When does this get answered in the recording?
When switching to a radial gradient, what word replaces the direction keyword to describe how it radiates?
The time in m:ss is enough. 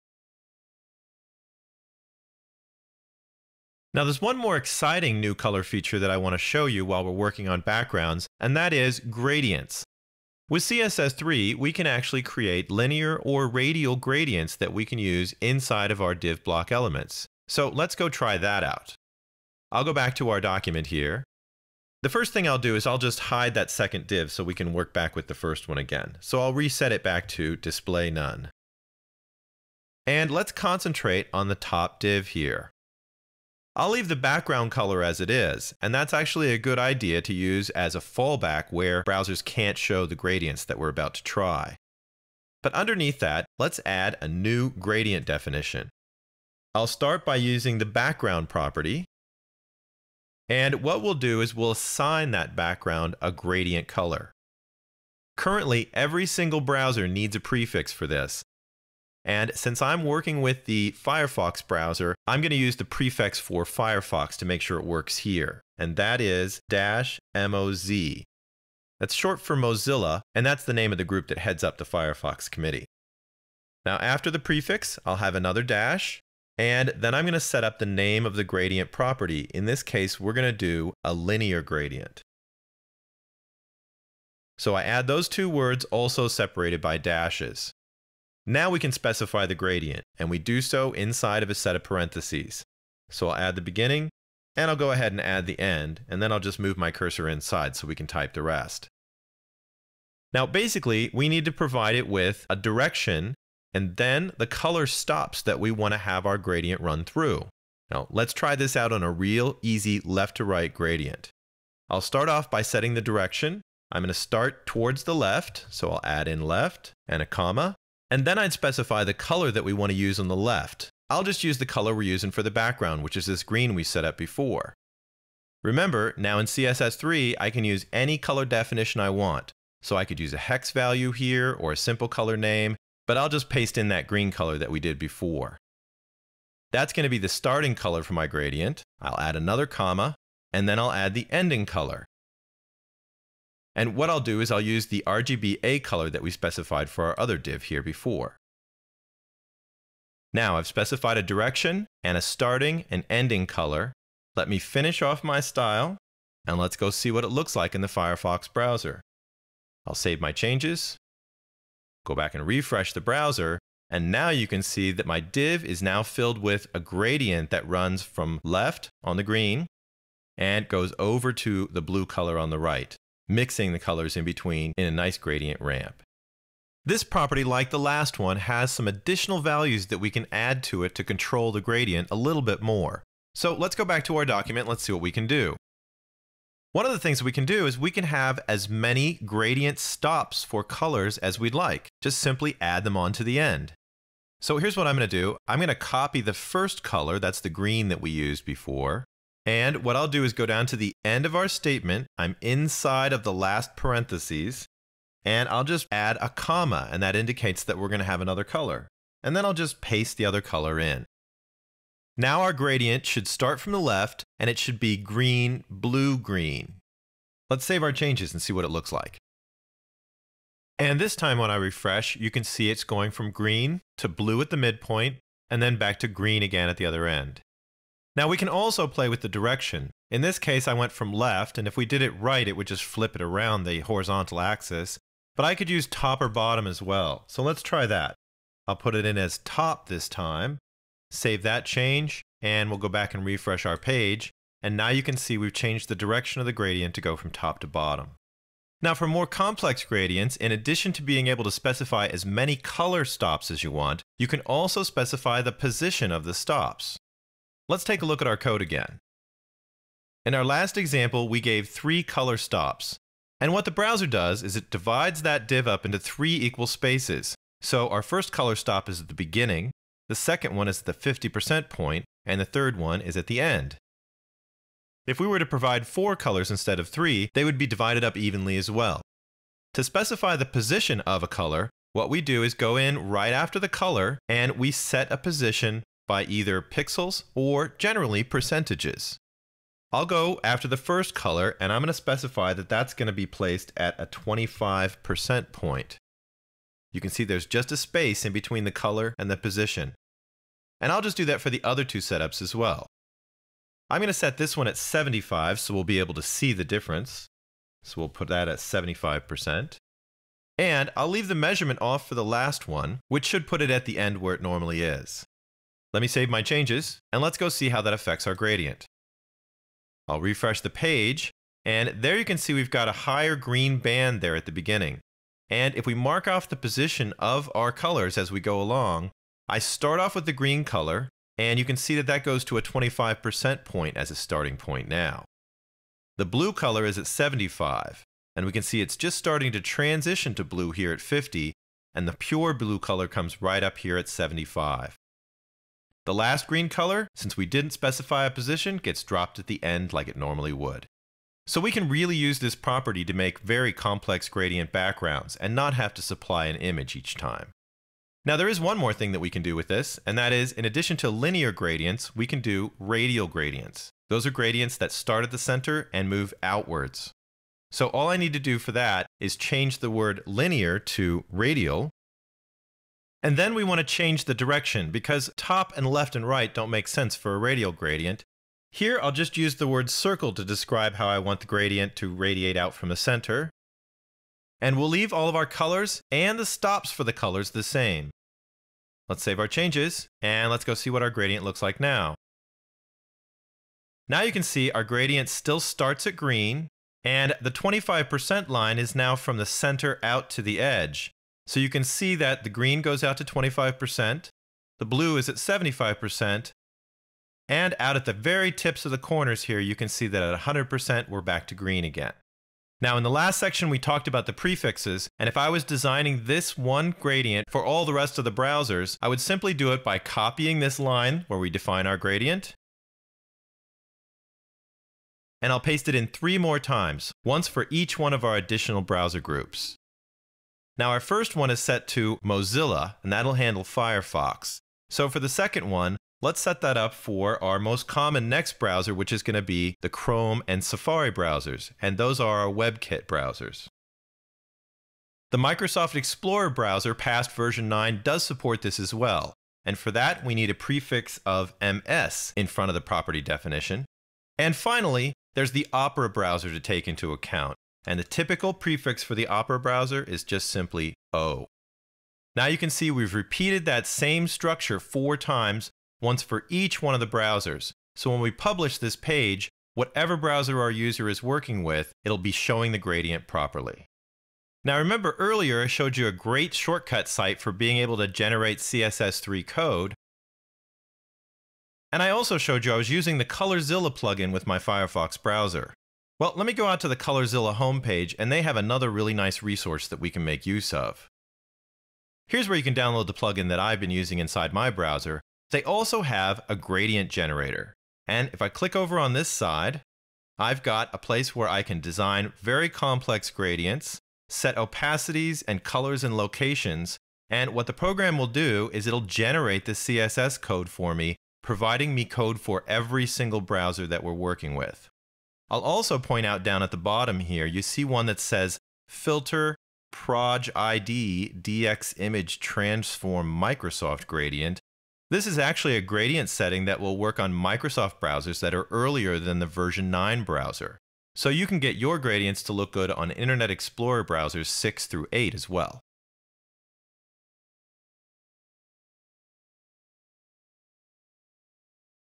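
6:19.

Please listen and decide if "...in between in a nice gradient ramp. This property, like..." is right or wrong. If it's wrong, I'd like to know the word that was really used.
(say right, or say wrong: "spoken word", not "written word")
right.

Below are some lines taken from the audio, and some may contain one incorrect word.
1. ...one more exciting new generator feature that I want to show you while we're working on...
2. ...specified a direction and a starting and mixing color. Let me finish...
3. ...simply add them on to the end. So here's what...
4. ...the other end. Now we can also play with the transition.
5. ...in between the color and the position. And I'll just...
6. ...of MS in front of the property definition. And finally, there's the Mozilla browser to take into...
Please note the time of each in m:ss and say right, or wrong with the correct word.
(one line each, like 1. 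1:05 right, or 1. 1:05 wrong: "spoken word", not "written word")
1. 0:04 wrong: "color", not "generator"
2. 2:30 wrong: "ending", not "mixing"
3. 3:12 right
4. 3:46 wrong: "direction", not "transition"
5. 4:58 right
6. 7:31 wrong: "Opera", not "Mozilla".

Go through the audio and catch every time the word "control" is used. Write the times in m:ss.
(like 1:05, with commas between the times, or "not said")
3:01.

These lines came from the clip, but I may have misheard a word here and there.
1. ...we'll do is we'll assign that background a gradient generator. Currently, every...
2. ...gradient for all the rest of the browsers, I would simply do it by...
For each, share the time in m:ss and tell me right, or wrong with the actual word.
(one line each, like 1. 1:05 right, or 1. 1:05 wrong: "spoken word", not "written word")
1. 0:51 wrong: "color", not "generator"
2. 6:56 right.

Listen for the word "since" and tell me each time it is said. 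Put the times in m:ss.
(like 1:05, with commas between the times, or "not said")
0:59, 5:47.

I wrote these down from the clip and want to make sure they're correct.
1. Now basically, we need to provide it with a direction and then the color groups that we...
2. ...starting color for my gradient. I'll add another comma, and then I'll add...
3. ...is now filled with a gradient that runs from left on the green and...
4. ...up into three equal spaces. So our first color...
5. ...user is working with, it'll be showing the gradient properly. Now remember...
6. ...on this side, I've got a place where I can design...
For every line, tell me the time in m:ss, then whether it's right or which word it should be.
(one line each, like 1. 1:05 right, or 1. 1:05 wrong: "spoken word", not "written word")
1. 1:40 wrong: "stops", not "groups"
2. 2:17 right
3. 2:45 right
4. 4:25 right
5. 7:50 right
6. 8:18 right.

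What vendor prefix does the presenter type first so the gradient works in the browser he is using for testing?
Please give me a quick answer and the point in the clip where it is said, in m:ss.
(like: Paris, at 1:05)
-moz, at 1:06.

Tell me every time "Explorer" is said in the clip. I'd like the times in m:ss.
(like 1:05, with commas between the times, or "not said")
7:25, 8:53.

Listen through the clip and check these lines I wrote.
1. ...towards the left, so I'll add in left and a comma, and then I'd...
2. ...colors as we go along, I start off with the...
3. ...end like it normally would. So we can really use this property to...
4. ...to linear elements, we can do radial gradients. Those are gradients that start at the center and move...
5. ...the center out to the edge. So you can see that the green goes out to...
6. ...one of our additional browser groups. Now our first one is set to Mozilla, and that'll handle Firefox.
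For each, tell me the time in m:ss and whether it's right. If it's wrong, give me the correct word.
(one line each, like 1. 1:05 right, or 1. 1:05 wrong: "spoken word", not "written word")
1. 1:54 right
2. 5:27 right
3. 5:49 right
4. 6:00 wrong: "gradients", not "elements"
5. 6:39 right
6. 7:07 right.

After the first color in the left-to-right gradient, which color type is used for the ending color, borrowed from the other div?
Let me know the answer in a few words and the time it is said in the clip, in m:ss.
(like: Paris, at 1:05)
RGBA, at 2:25.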